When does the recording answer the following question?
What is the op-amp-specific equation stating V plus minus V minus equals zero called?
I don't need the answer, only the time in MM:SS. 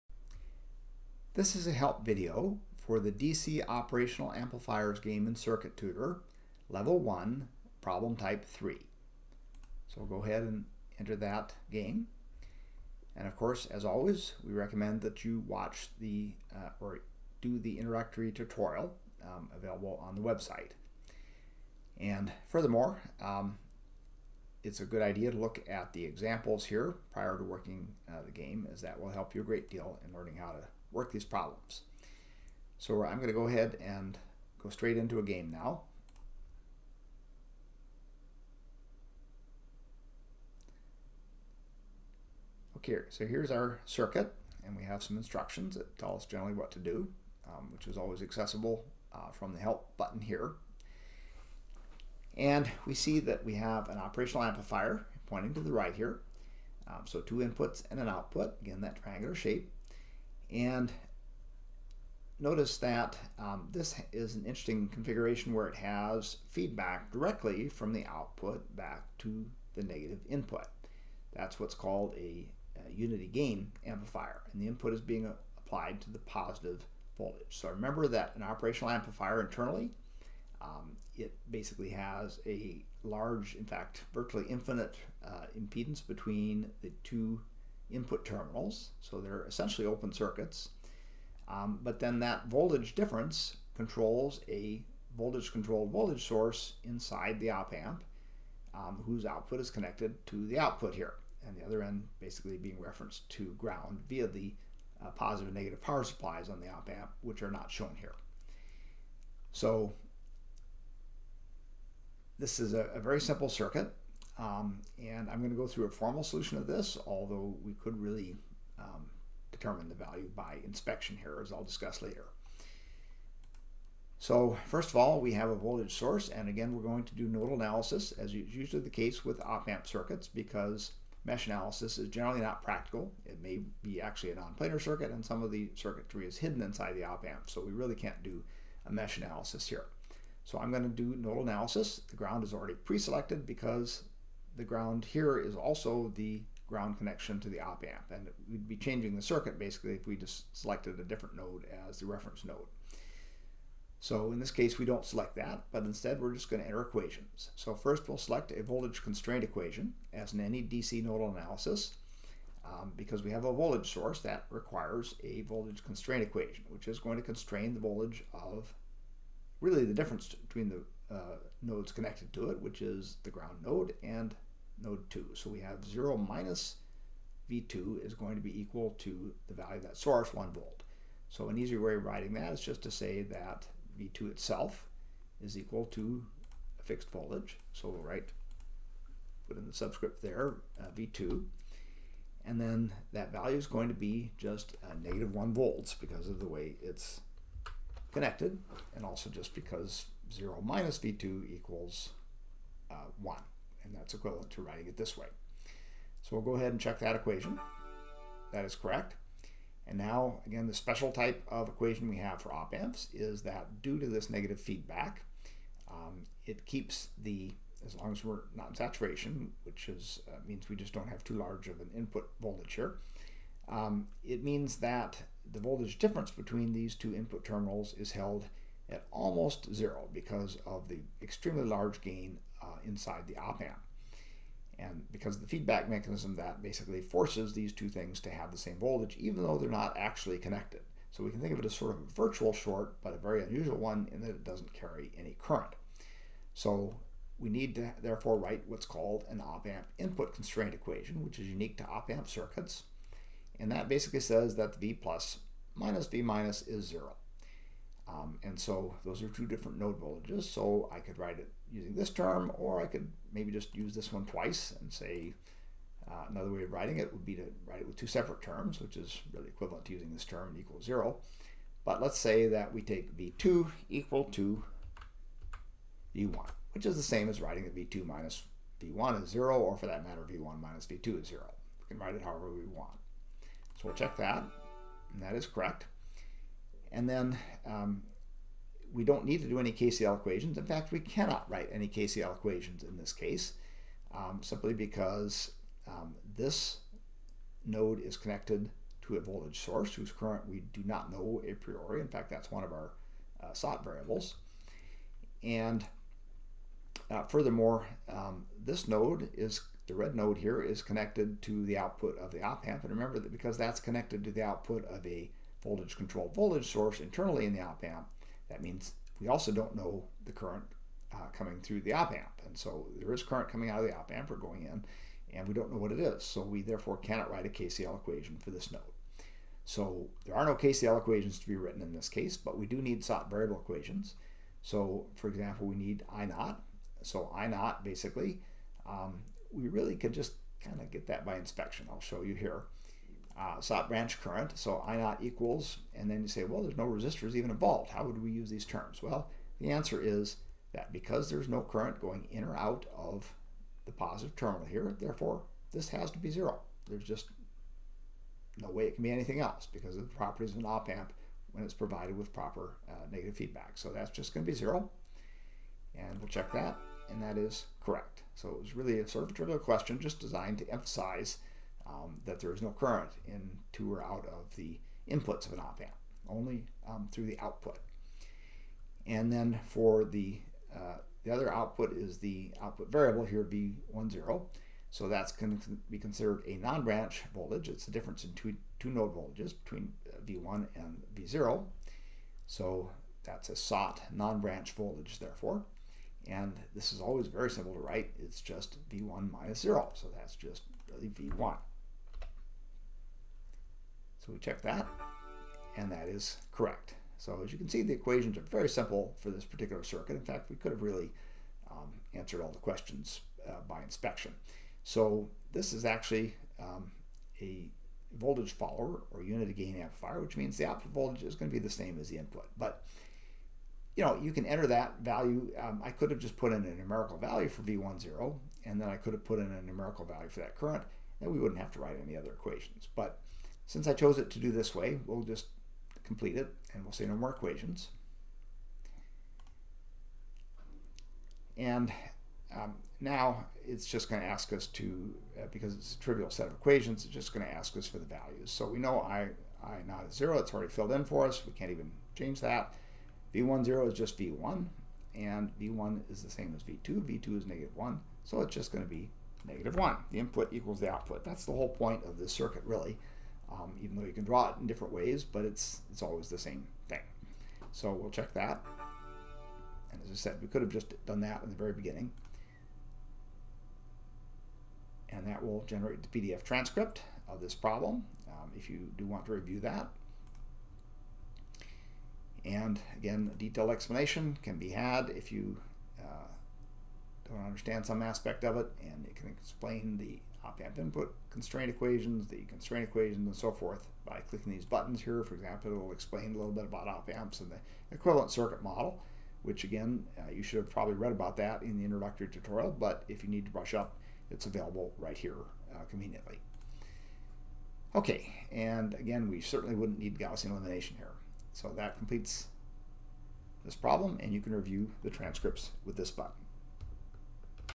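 04:09.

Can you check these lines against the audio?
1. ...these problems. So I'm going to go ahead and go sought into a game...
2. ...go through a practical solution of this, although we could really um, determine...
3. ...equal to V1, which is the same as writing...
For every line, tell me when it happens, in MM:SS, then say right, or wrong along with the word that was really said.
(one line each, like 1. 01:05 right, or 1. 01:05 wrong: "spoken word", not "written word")
1. 00:31 wrong: "straight", not "sought"
2. 01:55 wrong: "formal", not "practical"
3. 04:33 right.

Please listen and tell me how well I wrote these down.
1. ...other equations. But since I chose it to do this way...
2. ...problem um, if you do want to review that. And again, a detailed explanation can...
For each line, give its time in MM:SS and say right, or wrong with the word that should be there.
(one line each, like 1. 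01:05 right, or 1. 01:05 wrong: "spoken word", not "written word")
1. 07:12 right
2. 07:57 right.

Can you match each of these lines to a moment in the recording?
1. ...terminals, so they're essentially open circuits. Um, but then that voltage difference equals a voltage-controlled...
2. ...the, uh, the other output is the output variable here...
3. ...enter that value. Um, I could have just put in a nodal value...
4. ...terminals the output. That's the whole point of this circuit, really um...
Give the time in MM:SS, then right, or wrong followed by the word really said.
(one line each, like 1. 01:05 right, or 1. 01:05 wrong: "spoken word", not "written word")
1. 01:28 wrong: "controls", not "equals"
2. 06:20 right
3. 07:04 wrong: "numerical", not "nodal"
4. 07:40 wrong: "equals", not "terminals".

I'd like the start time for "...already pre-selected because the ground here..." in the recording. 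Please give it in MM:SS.
02:22.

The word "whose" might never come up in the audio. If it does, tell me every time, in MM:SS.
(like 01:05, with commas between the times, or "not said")
01:39, 04:59.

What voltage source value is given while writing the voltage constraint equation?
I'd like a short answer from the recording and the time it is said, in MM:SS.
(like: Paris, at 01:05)
1 volt, at 03:00.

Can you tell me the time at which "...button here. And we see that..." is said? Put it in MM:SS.
00:49.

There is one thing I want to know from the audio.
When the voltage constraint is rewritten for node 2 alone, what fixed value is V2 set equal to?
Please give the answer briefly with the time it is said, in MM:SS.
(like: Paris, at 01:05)
-1 volts, at 03:15.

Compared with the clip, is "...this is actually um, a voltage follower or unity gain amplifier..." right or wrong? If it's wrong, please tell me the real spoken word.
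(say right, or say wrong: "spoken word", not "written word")
right.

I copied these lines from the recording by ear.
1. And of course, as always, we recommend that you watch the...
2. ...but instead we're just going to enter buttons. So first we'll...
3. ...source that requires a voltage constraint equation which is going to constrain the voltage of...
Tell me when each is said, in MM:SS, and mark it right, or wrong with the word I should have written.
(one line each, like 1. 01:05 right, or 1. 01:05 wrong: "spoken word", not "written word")
1. 00:13 right
2. 02:35 wrong: "equations", not "buttons"
3. 02:43 right.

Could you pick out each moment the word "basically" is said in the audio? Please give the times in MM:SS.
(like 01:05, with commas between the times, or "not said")
01:21, 01:42, 02:29, 03:56, 04:13, 05:37.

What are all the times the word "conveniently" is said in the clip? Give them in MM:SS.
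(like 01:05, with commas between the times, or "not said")
08:25.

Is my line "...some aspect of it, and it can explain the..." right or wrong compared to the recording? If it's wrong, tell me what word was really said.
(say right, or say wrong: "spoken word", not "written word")
right.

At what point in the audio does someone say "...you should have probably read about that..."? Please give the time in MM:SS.
08:20.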